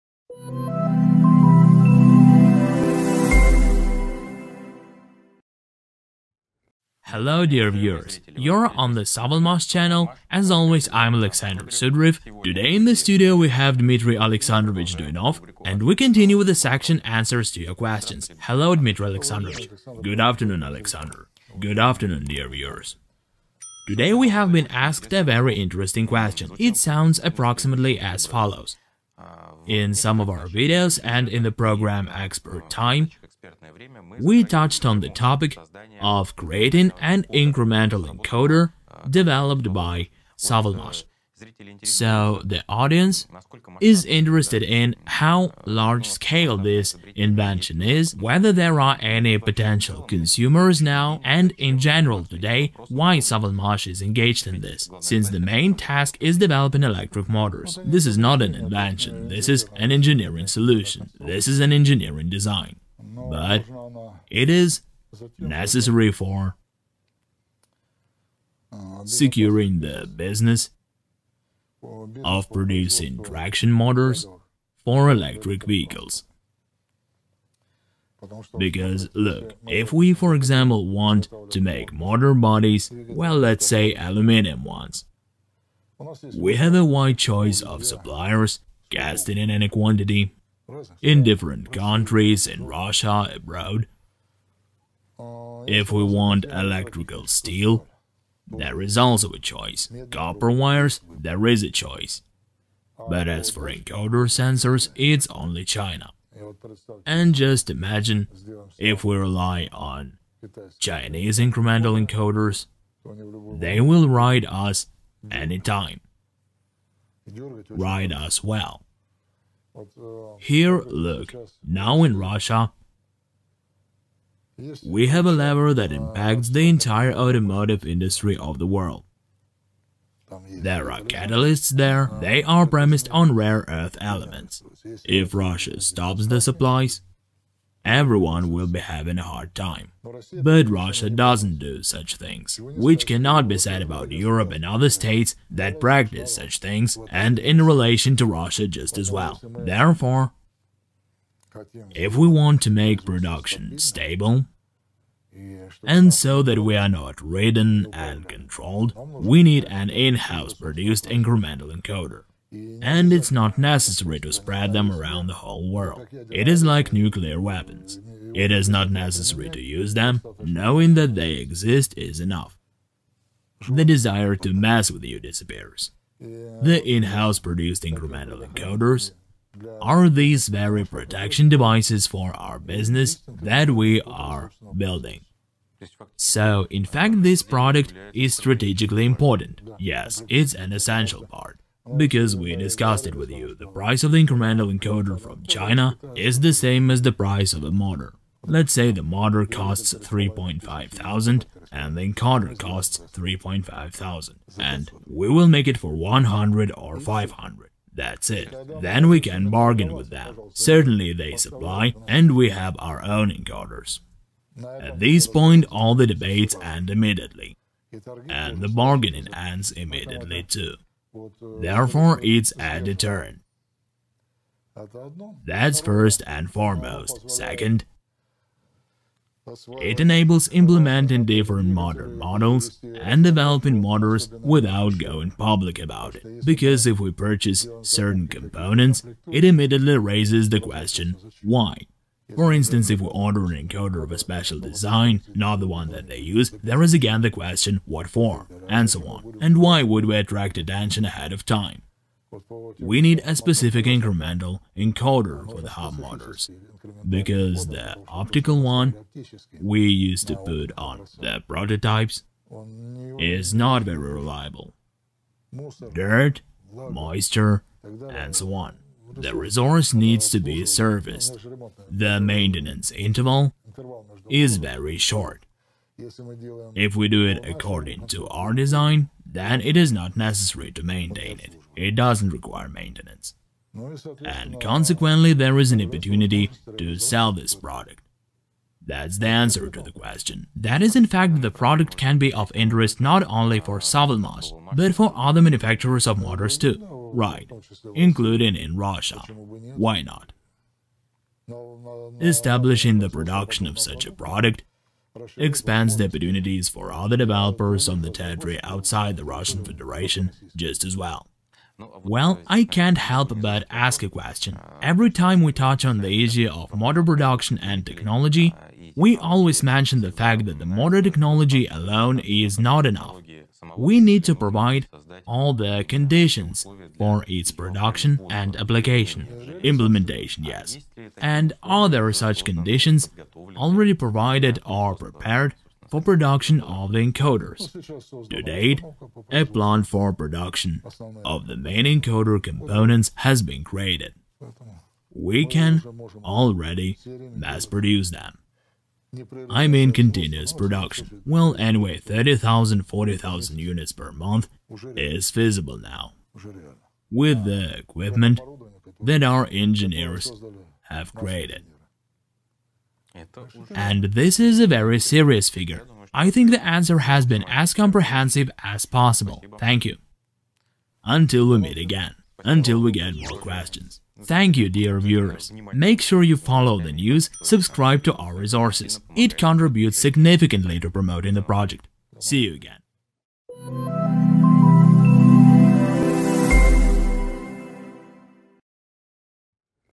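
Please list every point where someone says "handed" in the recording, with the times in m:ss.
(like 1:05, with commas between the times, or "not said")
not said.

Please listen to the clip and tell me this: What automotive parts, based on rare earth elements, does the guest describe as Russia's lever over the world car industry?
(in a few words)
Catalysts.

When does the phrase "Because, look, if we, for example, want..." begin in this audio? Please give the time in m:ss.
1:18.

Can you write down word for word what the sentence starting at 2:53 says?
The desire to mess with you disappears.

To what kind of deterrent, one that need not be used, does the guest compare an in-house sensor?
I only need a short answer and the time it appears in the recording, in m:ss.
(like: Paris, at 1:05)
Nuclear weapons, at 2:46.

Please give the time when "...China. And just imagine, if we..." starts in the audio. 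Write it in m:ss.
1:45.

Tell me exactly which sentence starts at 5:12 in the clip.
Well, I can't help but ask a question.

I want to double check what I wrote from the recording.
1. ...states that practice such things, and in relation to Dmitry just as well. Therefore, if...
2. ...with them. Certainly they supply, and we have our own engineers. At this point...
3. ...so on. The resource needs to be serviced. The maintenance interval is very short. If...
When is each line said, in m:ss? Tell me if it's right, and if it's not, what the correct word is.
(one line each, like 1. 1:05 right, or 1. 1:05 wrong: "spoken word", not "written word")
1. 2:24 wrong: "Russia", not "Dmitry"
2. 3:29 wrong: "encoders", not "engineers"
3. 4:28 right.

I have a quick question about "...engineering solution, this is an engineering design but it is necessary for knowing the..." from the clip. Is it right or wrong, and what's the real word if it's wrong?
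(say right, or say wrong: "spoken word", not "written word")
wrong: "securing", not "knowing".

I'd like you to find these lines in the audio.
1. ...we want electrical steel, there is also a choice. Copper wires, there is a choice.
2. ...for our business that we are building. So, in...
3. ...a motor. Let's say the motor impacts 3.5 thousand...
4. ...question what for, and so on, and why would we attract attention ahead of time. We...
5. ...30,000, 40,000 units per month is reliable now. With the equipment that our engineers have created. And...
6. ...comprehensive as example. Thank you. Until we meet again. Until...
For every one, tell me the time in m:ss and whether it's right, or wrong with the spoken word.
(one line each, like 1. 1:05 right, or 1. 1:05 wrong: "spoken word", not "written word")
1. 1:35 right
2. 3:02 right
3. 3:17 wrong: "costs", not "impacts"
4. 4:07 right
5. 5:51 wrong: "feasible", not "reliable"
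6. 6:07 wrong: "possible", not "example".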